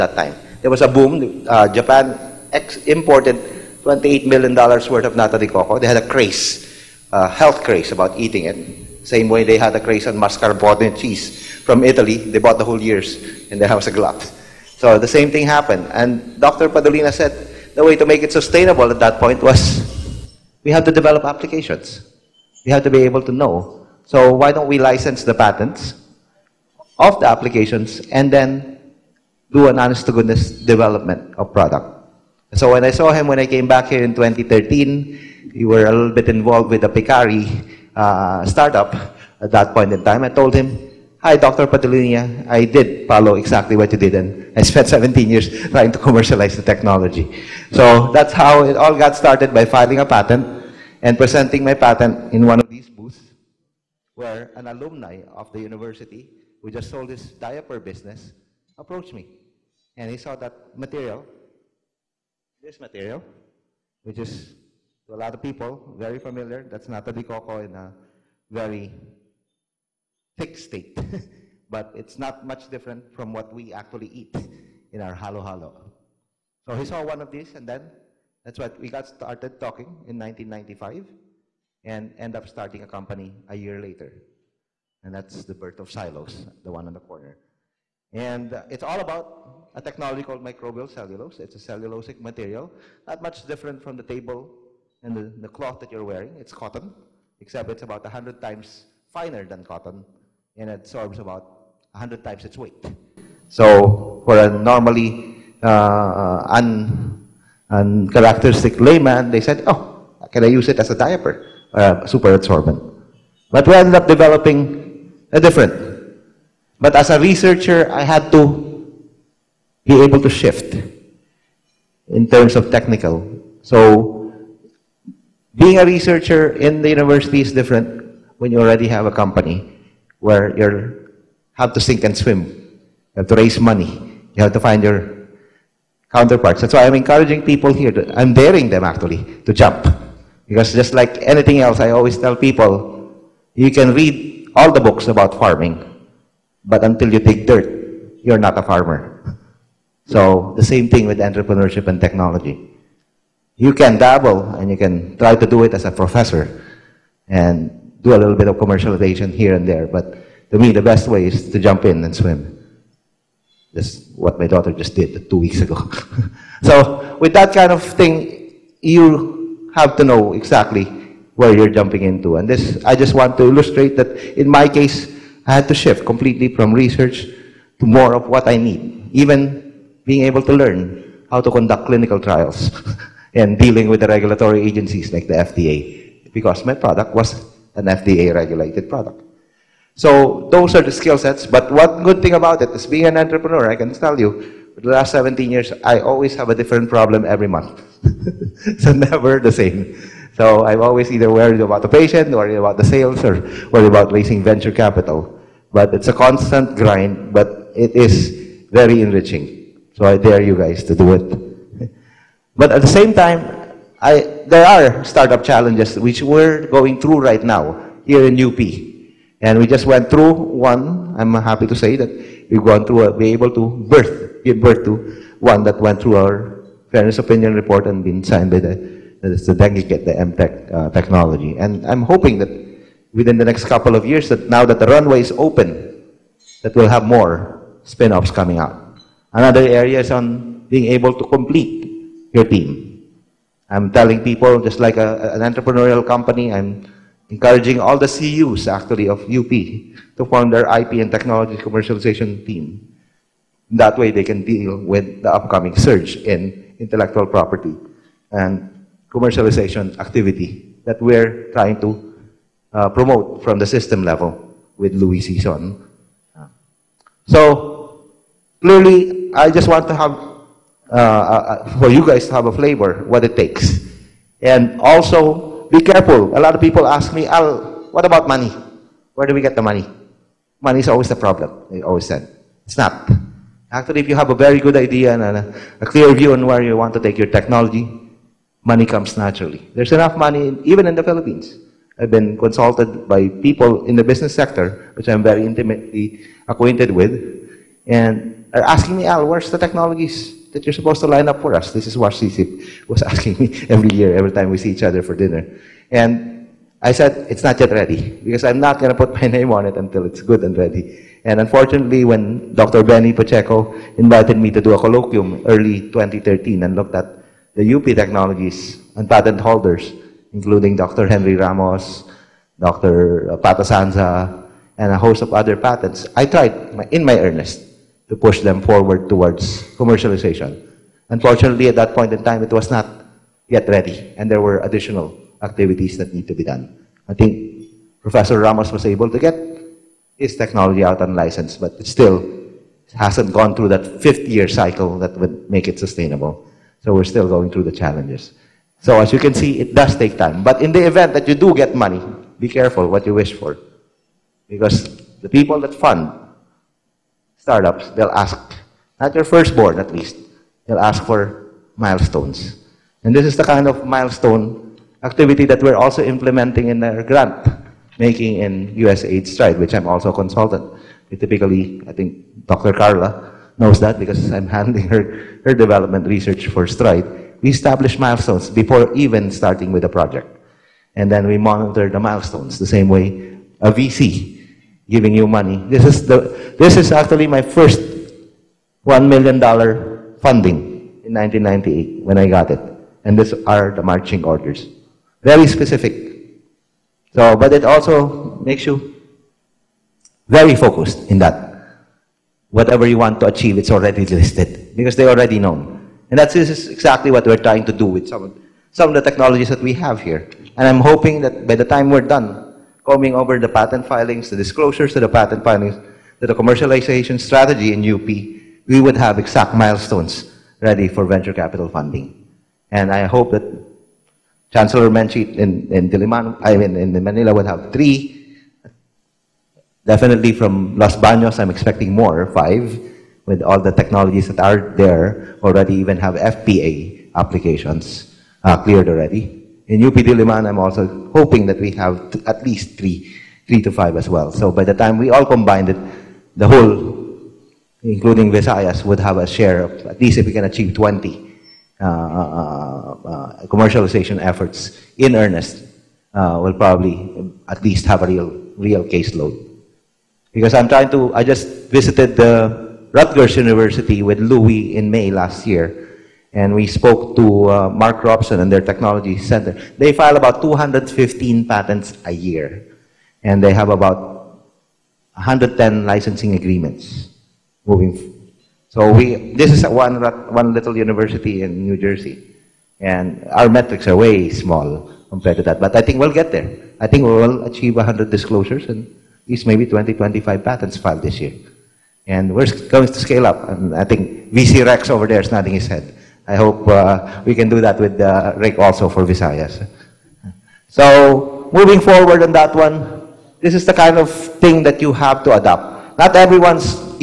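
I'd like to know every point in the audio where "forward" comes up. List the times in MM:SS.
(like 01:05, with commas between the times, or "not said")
05:28, 08:21.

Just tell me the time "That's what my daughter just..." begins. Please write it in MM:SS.
02:43.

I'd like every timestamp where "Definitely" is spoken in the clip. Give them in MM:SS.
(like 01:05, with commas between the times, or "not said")
07:09.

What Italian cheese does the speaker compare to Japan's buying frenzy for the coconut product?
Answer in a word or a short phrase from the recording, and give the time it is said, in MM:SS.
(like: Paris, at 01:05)
mascarpone, at 00:10.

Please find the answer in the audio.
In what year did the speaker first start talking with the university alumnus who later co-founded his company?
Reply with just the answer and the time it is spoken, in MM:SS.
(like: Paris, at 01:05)
1995, at 01:20.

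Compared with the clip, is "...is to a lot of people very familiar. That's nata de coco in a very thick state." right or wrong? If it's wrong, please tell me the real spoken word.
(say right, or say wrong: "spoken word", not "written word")
right.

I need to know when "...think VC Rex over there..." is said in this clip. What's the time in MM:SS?
08:13.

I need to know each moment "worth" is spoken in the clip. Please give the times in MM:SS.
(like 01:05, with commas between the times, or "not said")
00:04.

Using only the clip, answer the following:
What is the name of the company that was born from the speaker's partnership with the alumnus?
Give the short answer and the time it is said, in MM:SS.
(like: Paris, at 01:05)
Xylos, at 01:25.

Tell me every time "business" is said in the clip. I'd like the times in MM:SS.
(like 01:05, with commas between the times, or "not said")
00:57, 04:54.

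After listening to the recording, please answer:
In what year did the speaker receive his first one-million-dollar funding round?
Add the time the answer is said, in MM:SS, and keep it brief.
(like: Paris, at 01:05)
1998, at 06:31.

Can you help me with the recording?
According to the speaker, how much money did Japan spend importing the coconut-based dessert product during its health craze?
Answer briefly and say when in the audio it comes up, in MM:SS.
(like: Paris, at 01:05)
$28 million, at 00:03.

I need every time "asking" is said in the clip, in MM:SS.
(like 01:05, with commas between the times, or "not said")
04:58, 05:03.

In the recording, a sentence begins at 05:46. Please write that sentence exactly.
So we're still going through the challenges.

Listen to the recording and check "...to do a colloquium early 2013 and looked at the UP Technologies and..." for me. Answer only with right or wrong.
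right.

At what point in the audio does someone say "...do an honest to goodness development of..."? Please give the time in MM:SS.
00:29.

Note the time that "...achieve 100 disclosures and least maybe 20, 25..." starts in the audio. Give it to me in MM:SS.
08:07.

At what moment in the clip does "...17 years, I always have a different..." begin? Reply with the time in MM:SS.
03:15.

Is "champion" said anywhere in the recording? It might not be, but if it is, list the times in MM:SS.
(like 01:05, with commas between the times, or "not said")
not said.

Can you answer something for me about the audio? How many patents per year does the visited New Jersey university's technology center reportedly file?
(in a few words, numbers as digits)
215.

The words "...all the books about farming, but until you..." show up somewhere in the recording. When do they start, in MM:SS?
02:24.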